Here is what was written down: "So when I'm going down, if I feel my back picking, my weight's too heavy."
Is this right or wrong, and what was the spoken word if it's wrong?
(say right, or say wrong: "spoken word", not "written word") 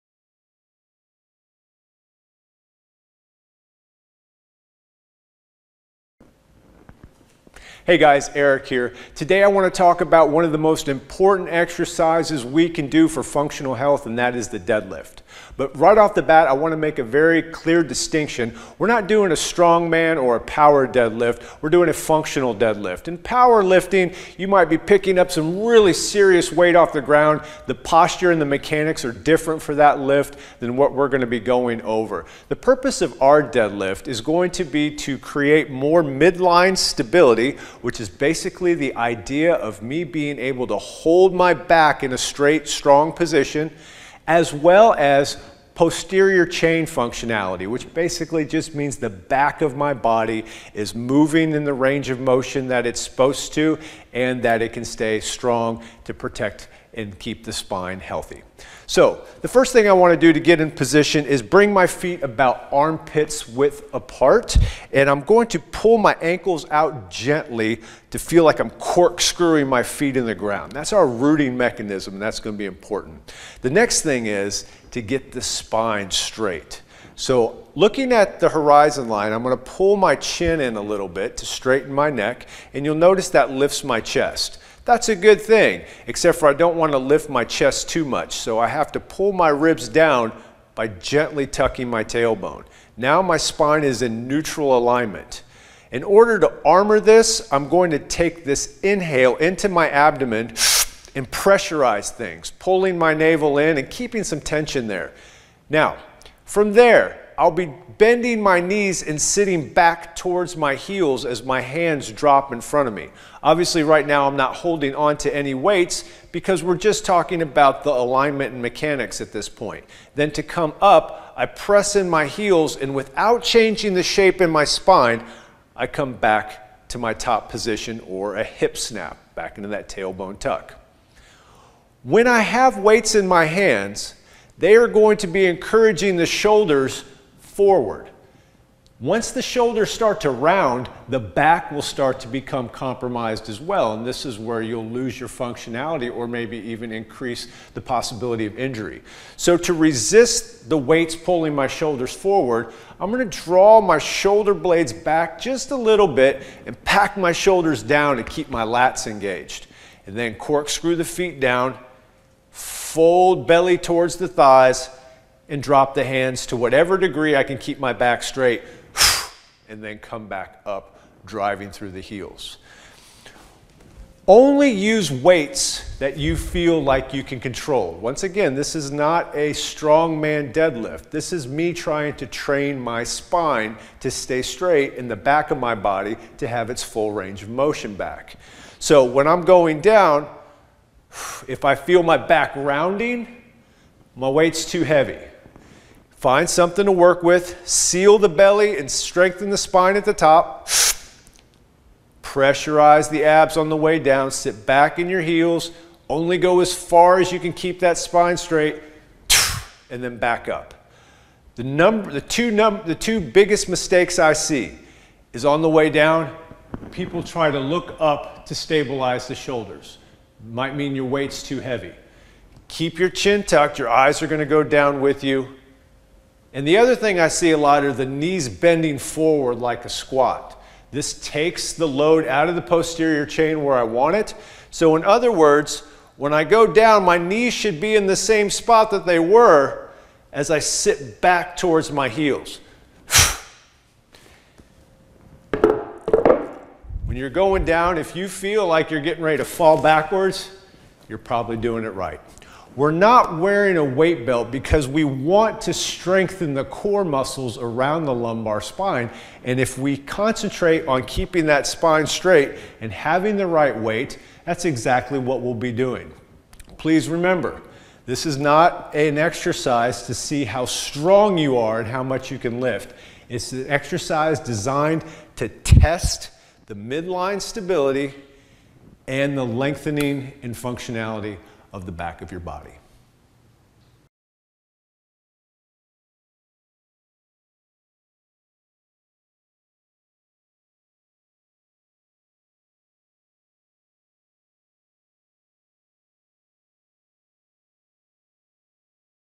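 wrong: "rounding", not "picking".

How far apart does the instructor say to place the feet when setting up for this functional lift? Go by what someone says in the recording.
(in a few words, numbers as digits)
Armpits width apart.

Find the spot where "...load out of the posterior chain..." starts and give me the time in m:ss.
3:51.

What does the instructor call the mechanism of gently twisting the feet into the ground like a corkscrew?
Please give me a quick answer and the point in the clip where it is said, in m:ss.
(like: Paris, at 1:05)
Rooting mechanism, at 1:11.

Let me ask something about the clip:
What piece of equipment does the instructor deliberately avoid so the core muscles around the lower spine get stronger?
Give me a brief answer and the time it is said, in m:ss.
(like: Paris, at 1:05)
Weight belt, at 4:13.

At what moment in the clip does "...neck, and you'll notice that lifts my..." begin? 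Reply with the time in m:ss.
1:22.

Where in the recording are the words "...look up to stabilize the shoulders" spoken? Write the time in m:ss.
3:37.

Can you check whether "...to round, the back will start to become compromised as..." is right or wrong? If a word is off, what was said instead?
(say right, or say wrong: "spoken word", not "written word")
right.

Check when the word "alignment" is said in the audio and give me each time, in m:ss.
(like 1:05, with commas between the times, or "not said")
1:34, 1:57.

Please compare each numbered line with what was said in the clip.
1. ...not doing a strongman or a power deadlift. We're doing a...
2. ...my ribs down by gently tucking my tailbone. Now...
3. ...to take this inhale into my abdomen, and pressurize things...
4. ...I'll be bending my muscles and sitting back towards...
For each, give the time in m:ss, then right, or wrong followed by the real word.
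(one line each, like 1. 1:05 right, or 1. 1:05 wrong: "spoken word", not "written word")
1. 0:18 right
2. 1:29 right
3. 1:37 right
4. 1:47 wrong: "knees", not "muscles".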